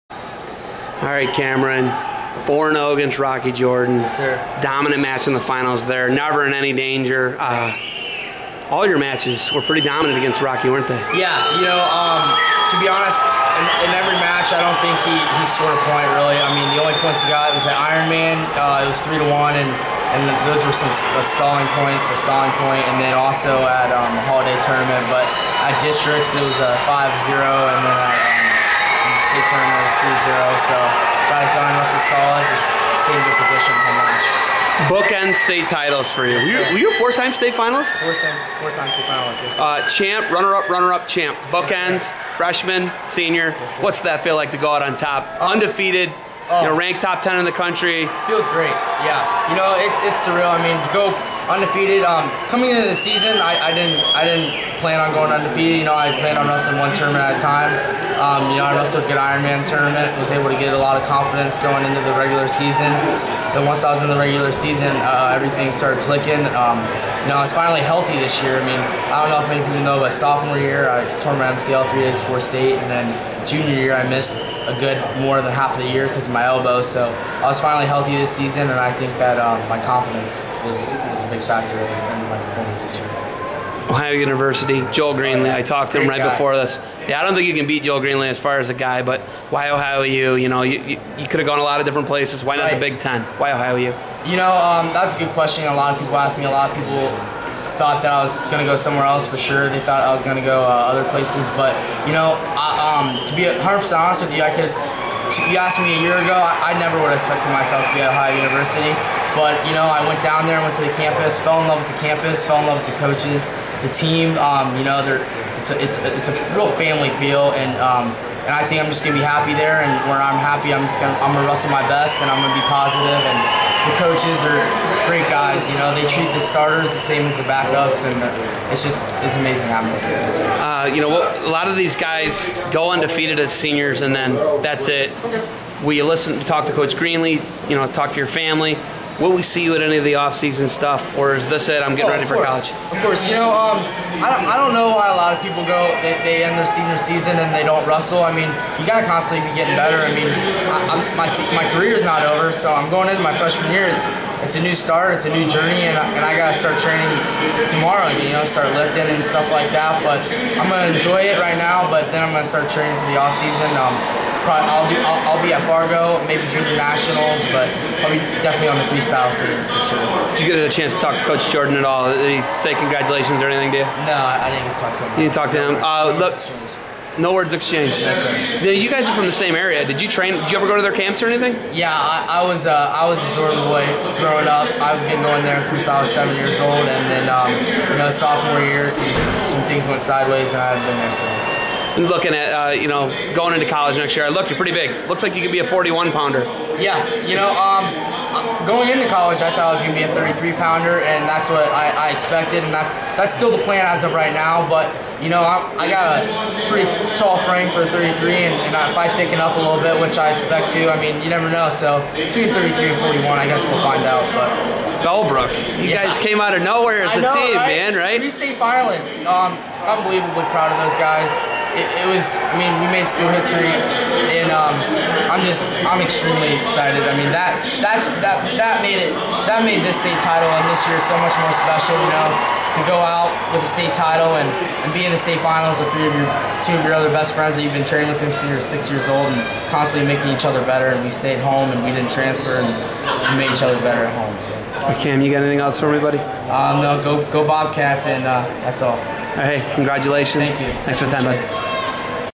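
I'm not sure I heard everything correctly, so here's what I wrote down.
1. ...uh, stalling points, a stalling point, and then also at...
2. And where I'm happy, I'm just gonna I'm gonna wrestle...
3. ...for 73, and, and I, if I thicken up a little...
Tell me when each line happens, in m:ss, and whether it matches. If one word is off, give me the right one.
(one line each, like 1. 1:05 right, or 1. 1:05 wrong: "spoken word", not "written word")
1. 0:21 right
2. 1:59 right
3. 3:27 wrong: "33", not "73".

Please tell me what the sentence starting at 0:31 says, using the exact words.
Russell solid, just stayed to position the match.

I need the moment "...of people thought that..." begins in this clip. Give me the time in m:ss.
1:36.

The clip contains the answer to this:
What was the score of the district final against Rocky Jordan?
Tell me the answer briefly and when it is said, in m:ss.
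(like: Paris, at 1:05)
5-0, at 0:26.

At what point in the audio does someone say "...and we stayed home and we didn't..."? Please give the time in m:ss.
4:00.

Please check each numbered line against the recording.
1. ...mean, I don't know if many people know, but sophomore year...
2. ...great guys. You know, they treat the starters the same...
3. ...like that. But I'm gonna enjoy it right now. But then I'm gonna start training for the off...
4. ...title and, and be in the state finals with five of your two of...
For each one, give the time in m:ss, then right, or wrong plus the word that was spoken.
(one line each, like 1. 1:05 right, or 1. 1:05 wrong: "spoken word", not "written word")
1. 1:08 right
2. 2:05 right
3. 2:39 right
4. 3:53 wrong: "three", not "five".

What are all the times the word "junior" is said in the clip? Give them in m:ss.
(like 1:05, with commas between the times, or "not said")
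1:13, 2:46.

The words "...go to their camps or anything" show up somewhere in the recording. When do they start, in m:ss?
3:00.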